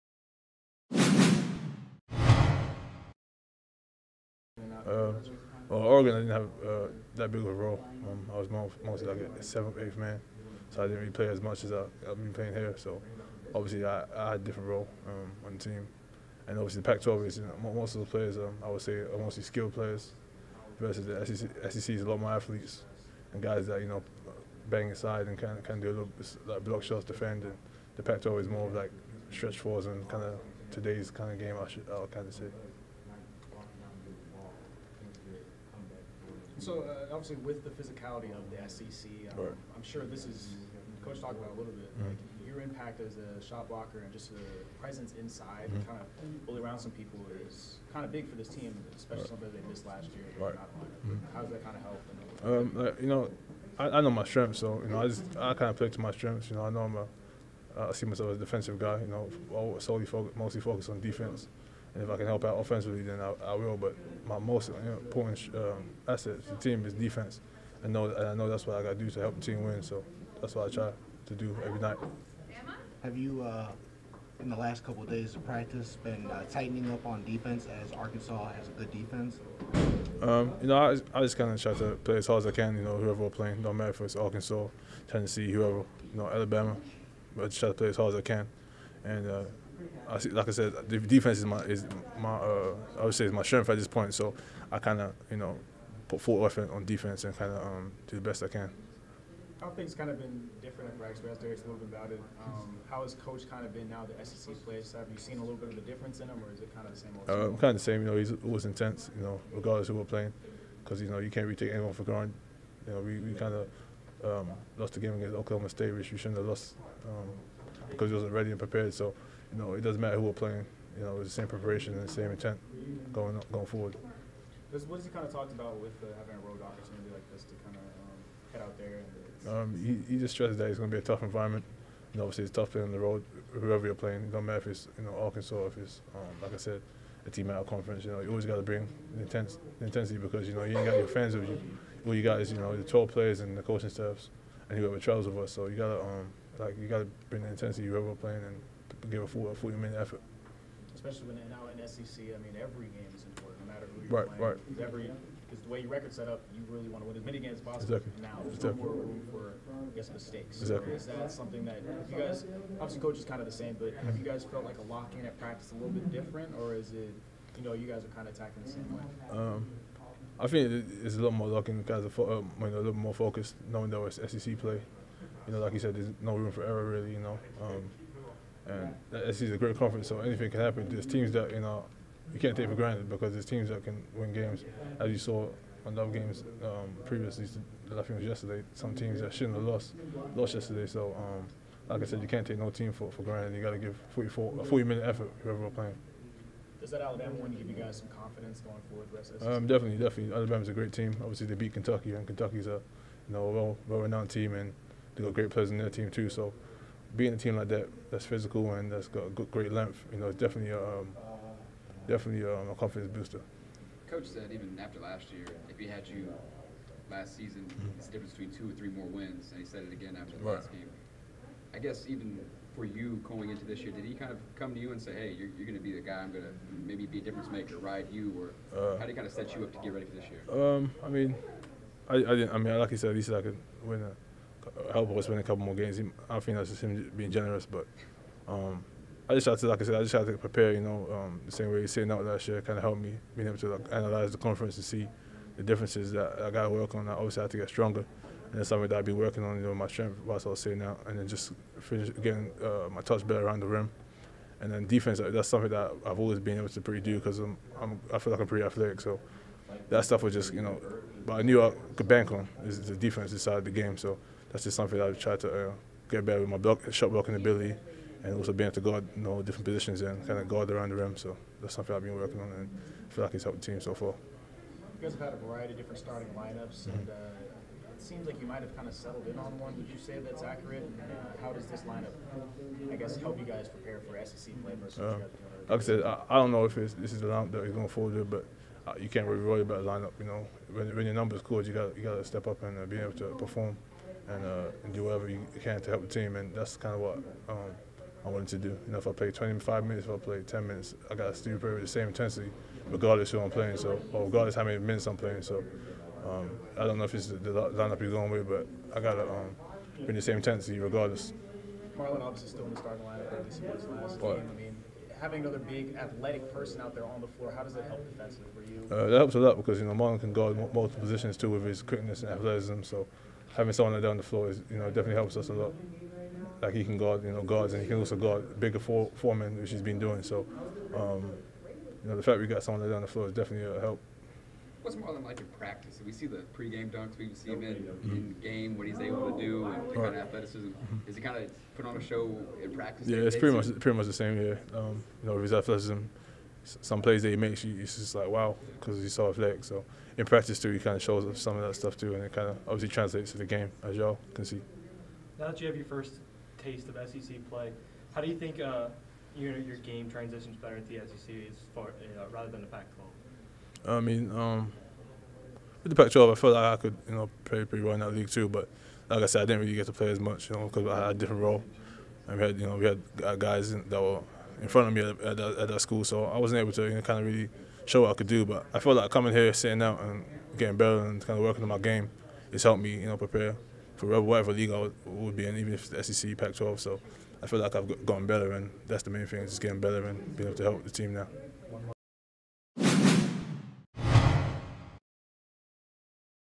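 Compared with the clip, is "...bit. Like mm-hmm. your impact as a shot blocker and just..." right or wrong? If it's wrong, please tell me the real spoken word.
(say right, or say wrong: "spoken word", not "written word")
right.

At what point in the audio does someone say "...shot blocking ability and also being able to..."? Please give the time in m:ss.
4:26.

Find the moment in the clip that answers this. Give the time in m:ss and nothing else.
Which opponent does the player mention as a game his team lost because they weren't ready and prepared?
1:55.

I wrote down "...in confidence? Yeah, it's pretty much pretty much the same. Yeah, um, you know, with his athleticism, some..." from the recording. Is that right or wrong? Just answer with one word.
wrong.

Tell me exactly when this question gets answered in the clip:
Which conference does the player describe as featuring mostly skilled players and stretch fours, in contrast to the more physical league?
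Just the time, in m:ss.
0:27.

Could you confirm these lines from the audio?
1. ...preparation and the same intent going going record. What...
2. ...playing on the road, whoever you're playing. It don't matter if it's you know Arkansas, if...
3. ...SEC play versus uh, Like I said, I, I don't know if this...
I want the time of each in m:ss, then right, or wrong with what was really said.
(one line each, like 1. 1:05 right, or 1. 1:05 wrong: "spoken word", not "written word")
1. 2:01 wrong: "forward", not "record"
2. 2:12 right
3. 4:44 right.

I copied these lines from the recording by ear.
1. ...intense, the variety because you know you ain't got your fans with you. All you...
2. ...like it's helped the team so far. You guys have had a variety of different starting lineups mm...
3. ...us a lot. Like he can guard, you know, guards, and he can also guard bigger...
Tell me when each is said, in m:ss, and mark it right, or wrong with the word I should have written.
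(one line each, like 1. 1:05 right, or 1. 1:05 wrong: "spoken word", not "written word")
1. 2:19 wrong: "intensity", not "variety"
2. 4:33 right
3. 5:25 right.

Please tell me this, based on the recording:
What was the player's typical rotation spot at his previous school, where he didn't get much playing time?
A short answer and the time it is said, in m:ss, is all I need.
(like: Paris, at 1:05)
seventh, eighth man, at 0:09.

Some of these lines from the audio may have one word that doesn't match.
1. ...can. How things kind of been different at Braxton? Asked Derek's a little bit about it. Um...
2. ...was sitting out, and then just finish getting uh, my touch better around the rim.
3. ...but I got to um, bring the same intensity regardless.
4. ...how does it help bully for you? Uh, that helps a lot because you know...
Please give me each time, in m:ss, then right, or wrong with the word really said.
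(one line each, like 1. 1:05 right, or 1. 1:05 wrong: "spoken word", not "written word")
1. 1:38 right
2. 4:10 right
3. 5:08 right
4. 5:17 wrong: "defensively", not "bully".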